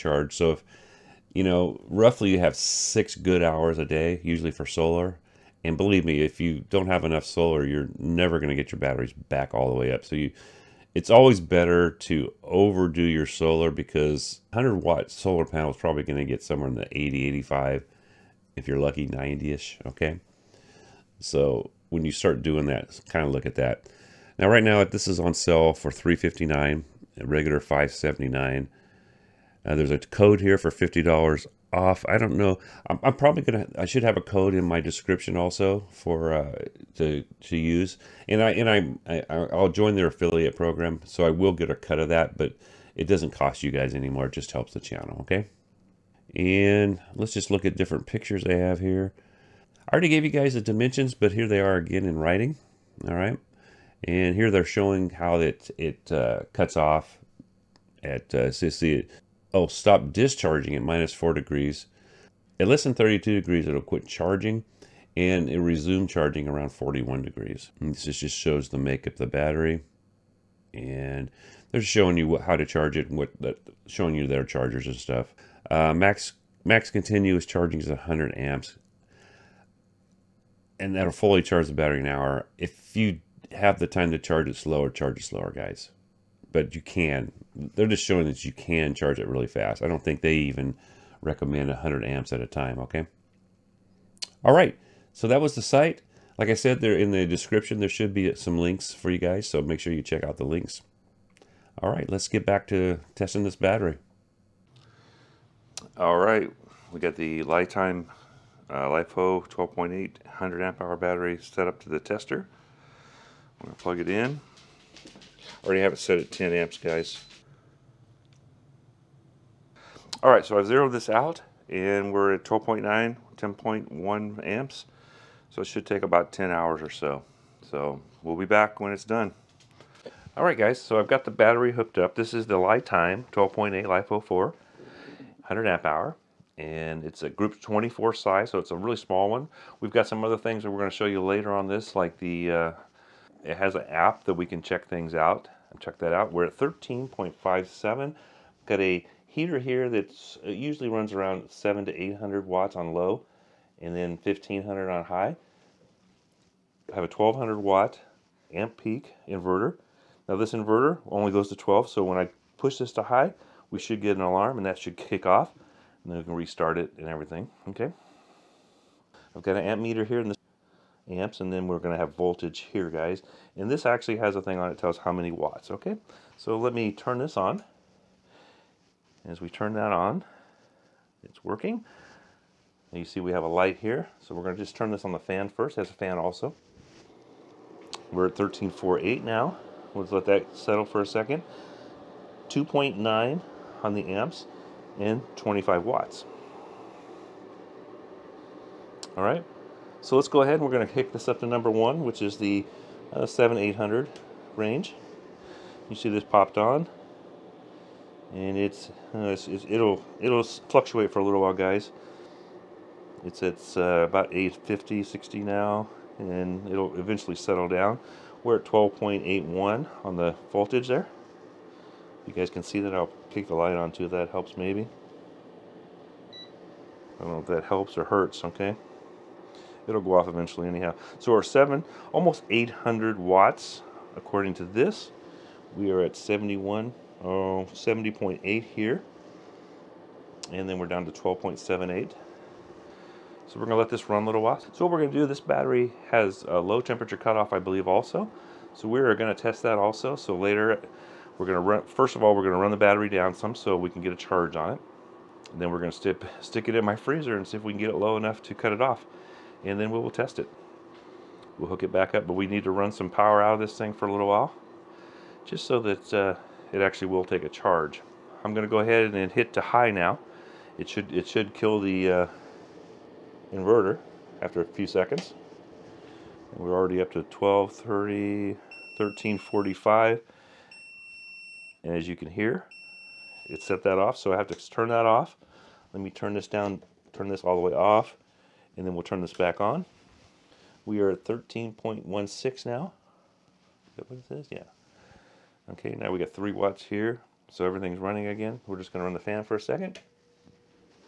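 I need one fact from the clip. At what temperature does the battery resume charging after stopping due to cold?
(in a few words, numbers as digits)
41 degrees.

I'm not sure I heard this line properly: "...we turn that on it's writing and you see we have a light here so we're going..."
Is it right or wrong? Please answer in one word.
wrong.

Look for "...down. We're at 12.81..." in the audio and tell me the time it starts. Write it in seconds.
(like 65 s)
217 s.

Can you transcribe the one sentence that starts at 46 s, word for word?
And let's just look at different pictures I have here.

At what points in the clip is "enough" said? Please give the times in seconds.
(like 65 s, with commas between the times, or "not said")
7 s, 258 s.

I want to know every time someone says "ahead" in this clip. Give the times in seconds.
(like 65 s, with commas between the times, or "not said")
200 s, 268 s.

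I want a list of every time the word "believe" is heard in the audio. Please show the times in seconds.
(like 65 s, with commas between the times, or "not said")
5 s, 247 s.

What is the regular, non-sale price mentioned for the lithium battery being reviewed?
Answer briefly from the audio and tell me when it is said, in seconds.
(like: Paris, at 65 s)
579, at 27 s.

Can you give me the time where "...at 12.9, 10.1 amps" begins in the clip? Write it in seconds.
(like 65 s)
122 s.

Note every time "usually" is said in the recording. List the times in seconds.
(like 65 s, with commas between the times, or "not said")
4 s, 150 s.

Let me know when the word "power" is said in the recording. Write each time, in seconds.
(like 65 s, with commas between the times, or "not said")
263 s.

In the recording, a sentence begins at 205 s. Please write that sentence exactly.
You see this popped on, and it's, uh, it's, it's, it'll it'll fluctuate for a little while, guys.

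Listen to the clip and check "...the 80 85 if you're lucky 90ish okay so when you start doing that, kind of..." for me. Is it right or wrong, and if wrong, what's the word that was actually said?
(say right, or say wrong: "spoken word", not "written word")
right.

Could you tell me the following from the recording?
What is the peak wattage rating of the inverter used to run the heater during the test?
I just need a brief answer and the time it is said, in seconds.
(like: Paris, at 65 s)
1200 watts, at 157 s.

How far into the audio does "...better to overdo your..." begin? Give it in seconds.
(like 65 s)
11 s.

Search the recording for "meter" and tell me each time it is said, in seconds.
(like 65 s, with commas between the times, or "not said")
169 s.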